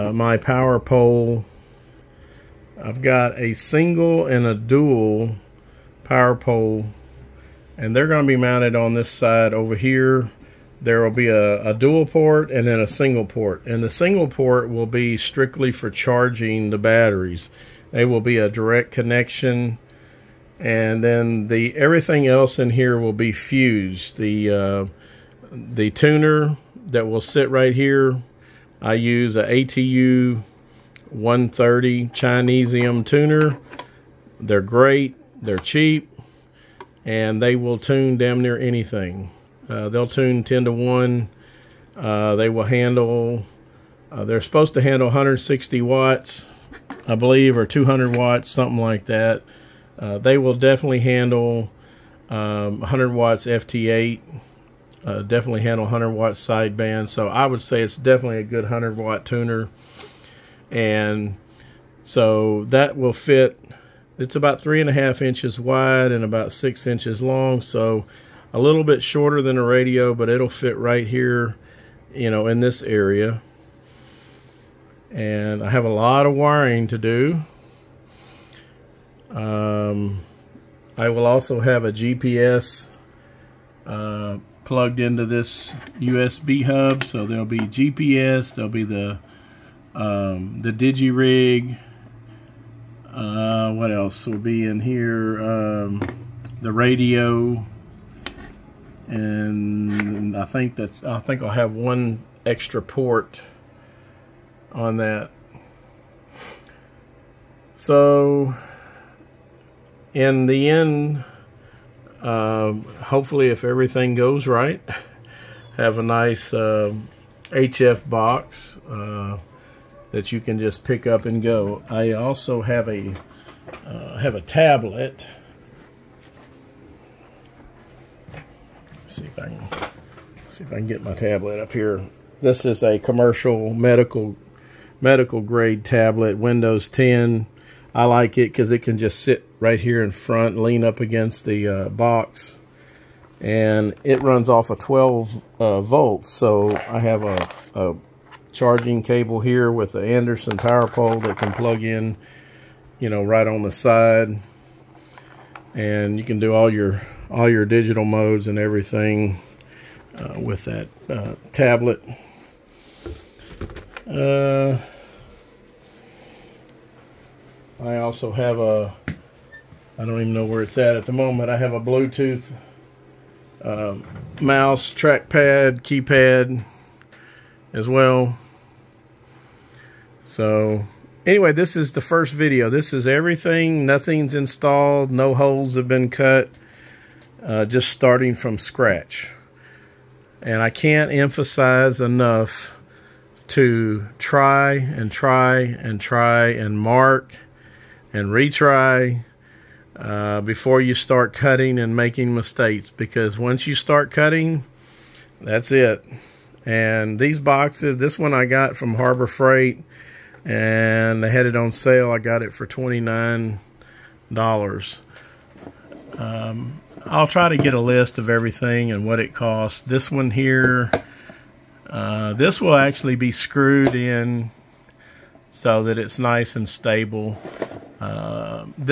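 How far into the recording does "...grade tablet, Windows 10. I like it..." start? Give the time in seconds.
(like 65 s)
135 s.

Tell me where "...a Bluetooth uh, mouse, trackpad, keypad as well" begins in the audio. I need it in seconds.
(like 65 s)
171 s.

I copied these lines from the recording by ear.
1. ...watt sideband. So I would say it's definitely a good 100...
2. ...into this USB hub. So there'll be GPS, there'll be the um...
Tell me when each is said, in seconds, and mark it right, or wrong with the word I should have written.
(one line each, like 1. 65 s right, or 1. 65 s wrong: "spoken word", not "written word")
1. 56 s right
2. 84 s right.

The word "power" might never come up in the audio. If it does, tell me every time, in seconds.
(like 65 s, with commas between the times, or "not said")
0 s, 6 s, 150 s.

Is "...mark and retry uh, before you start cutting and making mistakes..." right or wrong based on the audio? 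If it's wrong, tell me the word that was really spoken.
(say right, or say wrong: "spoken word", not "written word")
right.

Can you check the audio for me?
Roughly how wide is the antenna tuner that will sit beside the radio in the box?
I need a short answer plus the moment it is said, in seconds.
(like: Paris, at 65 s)
3.5 inches, at 64 s.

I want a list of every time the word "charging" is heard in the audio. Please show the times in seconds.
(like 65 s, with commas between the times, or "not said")
15 s, 148 s.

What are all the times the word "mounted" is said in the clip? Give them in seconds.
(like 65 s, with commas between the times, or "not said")
8 s.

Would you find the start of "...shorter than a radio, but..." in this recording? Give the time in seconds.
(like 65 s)
69 s.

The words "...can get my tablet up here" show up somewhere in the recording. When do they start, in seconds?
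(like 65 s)
130 s.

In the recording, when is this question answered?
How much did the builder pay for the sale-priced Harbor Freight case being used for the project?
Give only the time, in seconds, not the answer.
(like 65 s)
212 s.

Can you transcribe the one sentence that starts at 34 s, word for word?
They're great, they're cheap, and they will tune damn near anything.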